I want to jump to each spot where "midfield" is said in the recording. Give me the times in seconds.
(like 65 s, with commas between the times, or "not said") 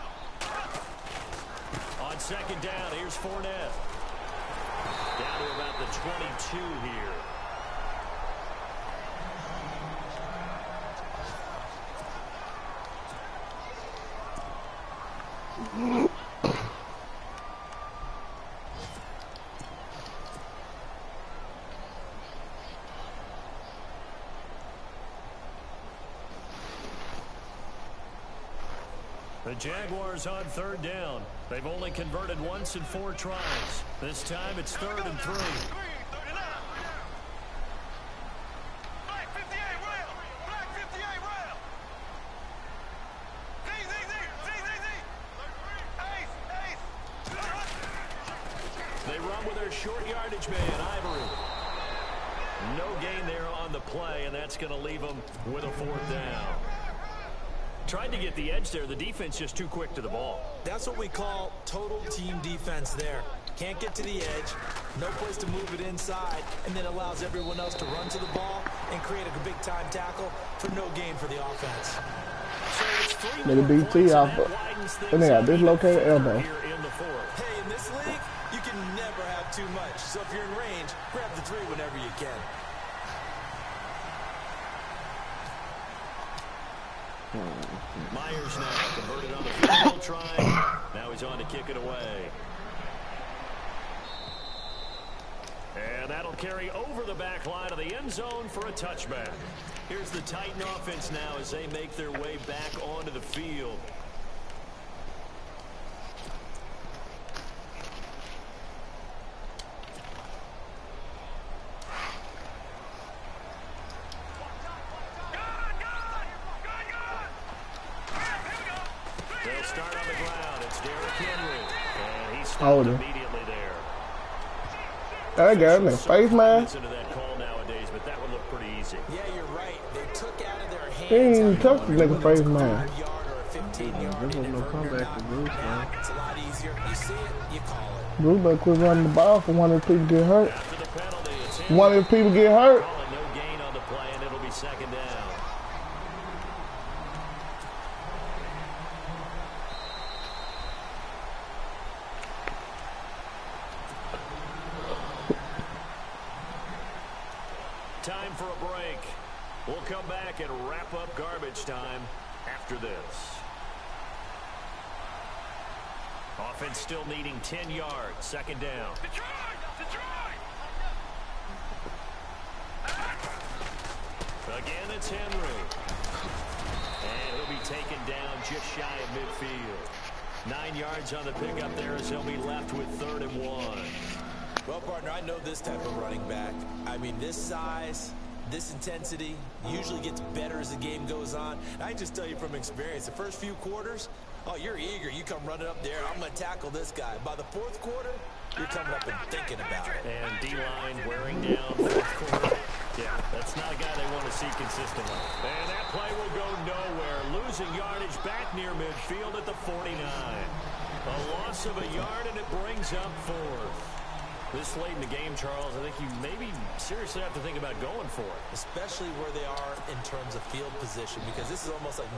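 179 s, 208 s.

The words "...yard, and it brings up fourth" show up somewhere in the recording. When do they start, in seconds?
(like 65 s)
211 s.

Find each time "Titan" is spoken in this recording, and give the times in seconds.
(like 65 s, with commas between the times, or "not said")
100 s.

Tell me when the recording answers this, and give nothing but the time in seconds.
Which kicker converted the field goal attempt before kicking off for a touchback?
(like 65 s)
88 s.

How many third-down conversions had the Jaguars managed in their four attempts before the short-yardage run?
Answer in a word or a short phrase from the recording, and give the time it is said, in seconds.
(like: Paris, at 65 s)
1, at 32 s.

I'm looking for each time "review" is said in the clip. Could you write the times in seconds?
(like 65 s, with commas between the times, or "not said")
not said.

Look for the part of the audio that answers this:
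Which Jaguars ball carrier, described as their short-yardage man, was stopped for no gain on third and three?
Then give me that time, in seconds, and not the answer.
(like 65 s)
50 s.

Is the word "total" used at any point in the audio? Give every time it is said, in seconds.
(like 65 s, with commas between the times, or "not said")
61 s.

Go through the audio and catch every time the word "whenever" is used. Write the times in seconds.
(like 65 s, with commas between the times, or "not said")
81 s.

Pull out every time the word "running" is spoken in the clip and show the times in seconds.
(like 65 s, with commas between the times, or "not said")
138 s, 185 s, 195 s.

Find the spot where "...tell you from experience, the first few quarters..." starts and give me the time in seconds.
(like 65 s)
192 s.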